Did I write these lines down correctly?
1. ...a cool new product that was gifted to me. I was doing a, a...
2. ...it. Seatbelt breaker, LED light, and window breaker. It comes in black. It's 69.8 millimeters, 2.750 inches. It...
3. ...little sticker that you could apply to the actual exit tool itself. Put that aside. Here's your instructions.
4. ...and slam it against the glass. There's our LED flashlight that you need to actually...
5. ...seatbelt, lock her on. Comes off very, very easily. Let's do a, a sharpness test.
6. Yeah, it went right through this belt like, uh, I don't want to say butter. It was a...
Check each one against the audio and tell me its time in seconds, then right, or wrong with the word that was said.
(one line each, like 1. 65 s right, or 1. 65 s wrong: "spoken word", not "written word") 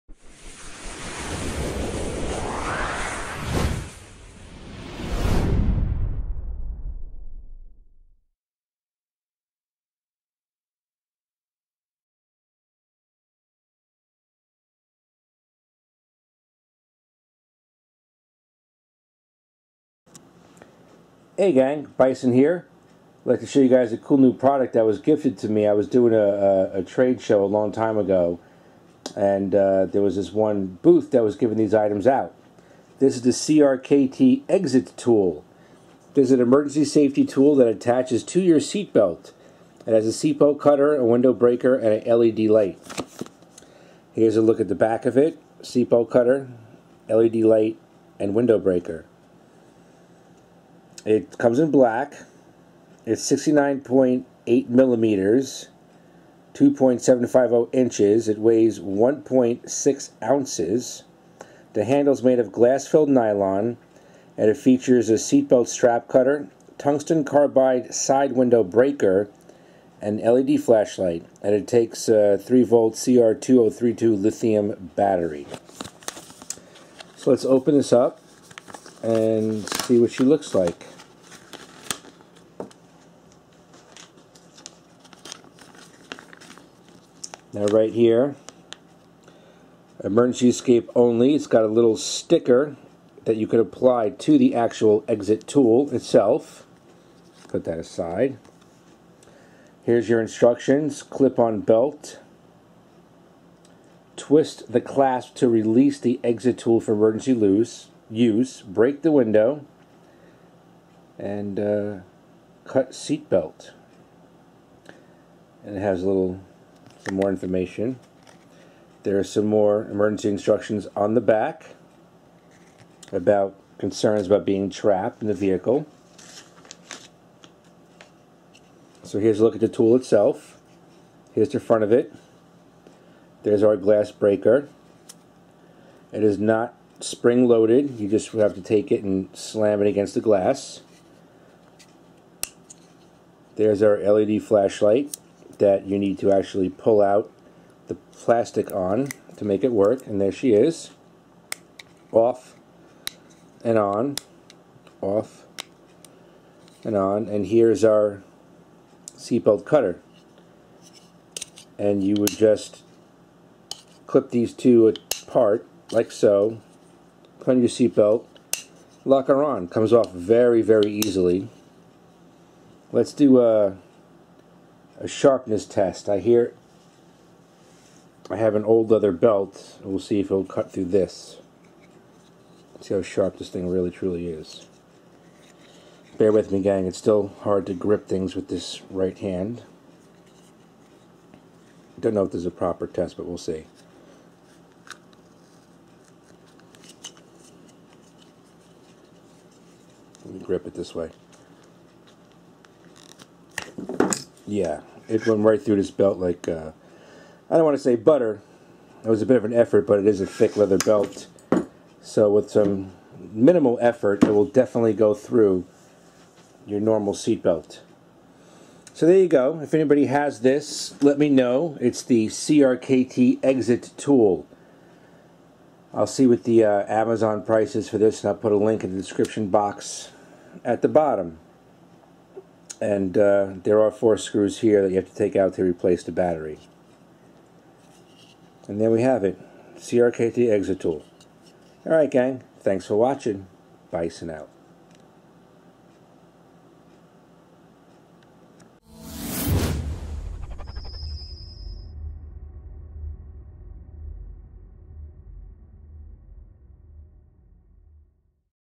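1. 23 s right
2. 45 s wrong: "cutter", not "breaker"
3. 91 s right
4. 139 s right
5. 167 s right
6. 204 s right.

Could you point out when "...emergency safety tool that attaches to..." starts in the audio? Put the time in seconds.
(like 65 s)
36 s.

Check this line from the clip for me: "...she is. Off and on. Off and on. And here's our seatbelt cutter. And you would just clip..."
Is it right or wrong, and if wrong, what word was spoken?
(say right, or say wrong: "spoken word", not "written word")
right.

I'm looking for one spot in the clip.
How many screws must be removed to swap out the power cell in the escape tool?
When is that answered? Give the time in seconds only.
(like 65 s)
233 s.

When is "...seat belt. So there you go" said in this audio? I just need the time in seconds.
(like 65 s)
217 s.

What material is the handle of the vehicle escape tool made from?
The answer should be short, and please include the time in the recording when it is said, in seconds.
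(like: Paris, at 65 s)
Glass-filled nylon, at 62 s.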